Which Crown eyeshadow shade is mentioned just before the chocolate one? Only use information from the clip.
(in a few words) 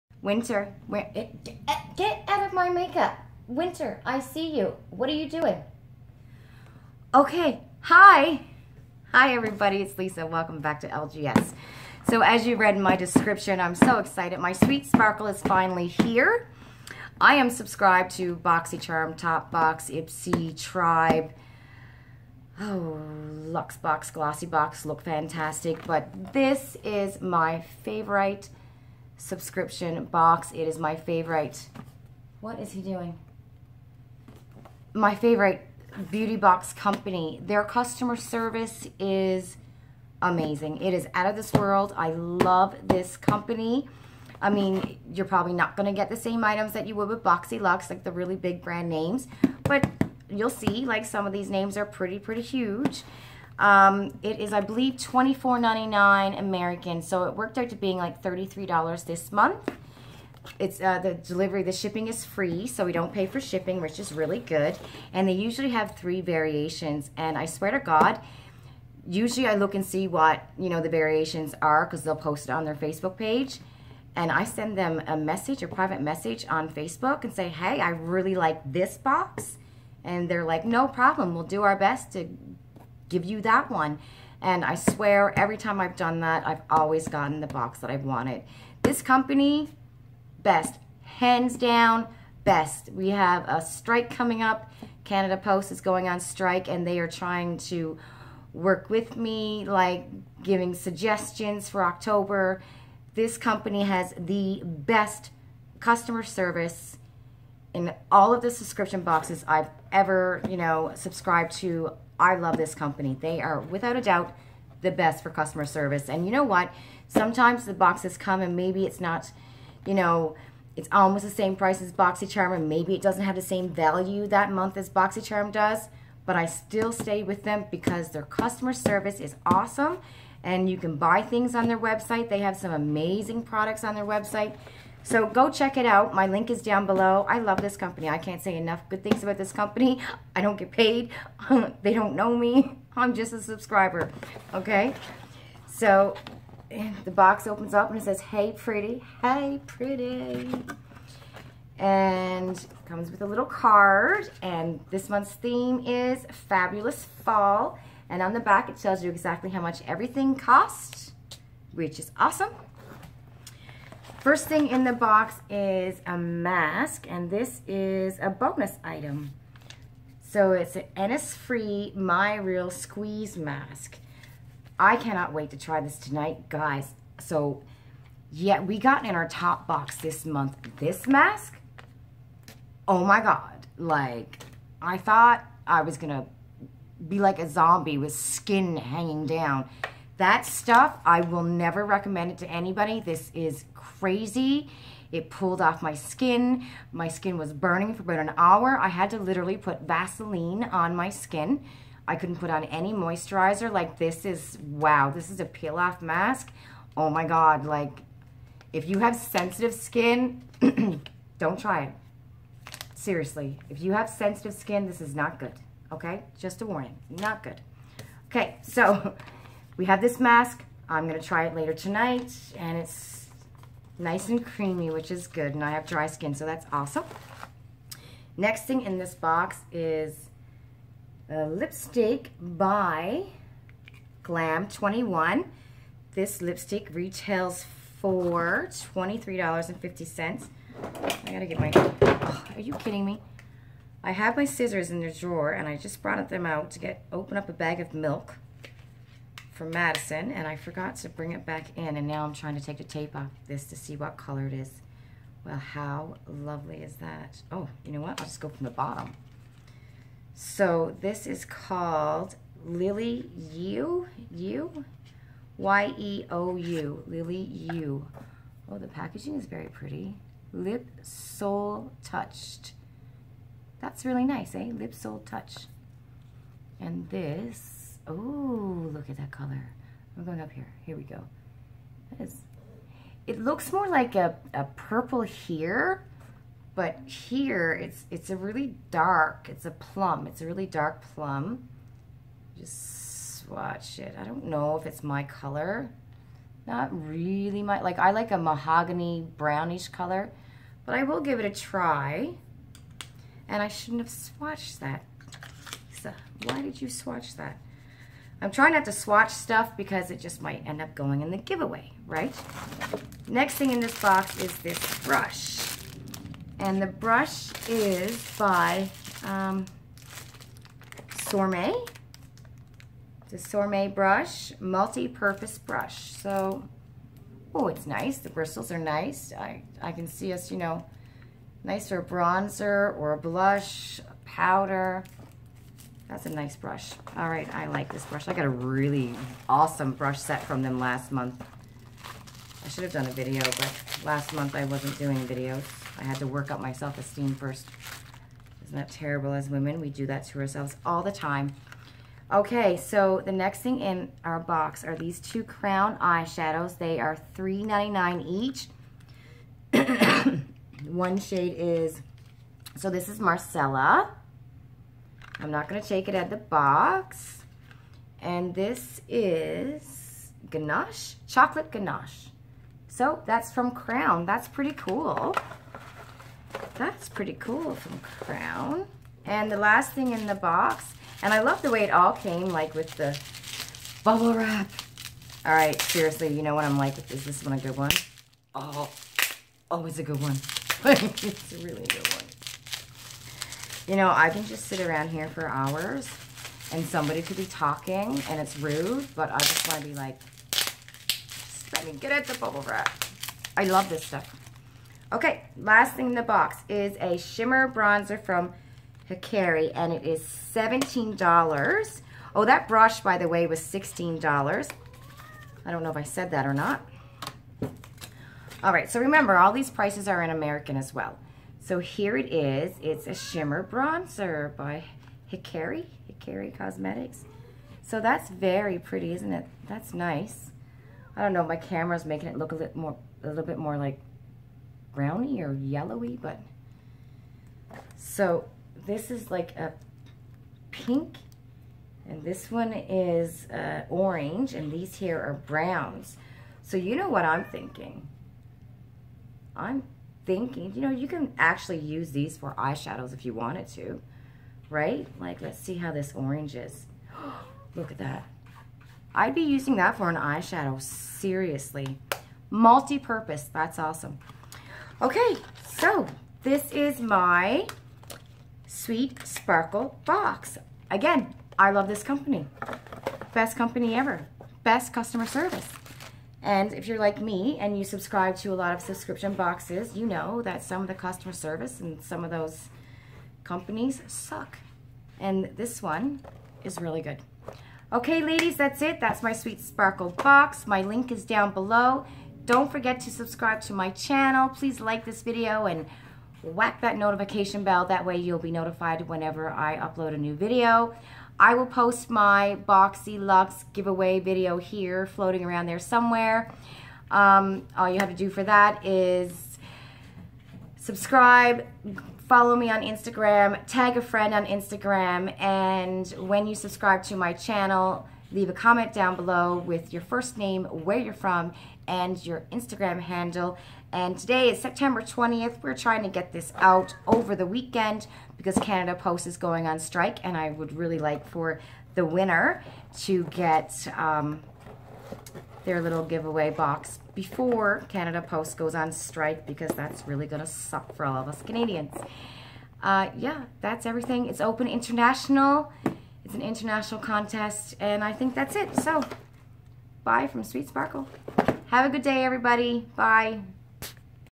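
Marcella.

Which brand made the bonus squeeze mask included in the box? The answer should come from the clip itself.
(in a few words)
Innisfree.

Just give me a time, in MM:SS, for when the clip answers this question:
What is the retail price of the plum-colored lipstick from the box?
03:58.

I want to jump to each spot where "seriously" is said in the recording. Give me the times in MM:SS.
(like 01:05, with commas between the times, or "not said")
03:32, 06:25, 07:40.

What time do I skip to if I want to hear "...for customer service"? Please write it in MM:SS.
01:55.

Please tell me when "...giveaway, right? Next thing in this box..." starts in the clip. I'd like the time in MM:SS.
05:11.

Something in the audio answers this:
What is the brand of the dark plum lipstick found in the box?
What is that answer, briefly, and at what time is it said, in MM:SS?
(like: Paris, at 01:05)
Glam 21, at 03:54.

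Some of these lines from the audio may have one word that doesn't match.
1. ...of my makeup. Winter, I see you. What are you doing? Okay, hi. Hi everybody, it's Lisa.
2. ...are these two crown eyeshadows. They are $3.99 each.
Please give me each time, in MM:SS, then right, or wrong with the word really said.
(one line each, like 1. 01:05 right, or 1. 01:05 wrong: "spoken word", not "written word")
1. 00:02 right
2. 05:54 right.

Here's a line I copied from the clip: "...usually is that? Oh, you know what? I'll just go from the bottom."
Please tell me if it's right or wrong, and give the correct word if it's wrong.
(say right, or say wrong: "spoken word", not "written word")
wrong: "lovely", not "usually".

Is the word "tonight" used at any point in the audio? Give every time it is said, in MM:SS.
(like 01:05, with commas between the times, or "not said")
02:55, 03:41.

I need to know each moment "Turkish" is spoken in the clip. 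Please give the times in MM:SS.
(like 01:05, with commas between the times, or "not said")
not said.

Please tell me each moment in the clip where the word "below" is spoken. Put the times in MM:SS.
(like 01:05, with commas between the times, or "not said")
02:16, 08:11, 08:39.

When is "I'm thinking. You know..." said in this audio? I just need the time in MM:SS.
07:29.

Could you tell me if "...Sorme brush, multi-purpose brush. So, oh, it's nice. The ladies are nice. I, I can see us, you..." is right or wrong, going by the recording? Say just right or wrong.
wrong.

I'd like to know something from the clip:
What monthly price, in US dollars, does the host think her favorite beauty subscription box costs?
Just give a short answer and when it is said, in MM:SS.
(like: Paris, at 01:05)
$24.99, at 00:54.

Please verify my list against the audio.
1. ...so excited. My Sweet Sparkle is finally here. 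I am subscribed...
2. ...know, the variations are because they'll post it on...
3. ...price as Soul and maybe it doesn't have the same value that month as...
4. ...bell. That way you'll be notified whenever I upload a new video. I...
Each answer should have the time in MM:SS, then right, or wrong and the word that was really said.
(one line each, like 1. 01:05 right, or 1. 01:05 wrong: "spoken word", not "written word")
1. 00:13 right
2. 01:10 right
3. 02:01 wrong: "BoxyCharm", not "Soul"
4. 08:17 right.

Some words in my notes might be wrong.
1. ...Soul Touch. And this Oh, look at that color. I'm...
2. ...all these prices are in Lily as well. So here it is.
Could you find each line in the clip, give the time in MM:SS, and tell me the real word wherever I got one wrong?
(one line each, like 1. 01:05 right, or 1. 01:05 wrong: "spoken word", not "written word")
1. 04:34 right
2. 06:59 wrong: "American", not "Lily".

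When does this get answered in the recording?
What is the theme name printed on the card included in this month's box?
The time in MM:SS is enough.
02:36.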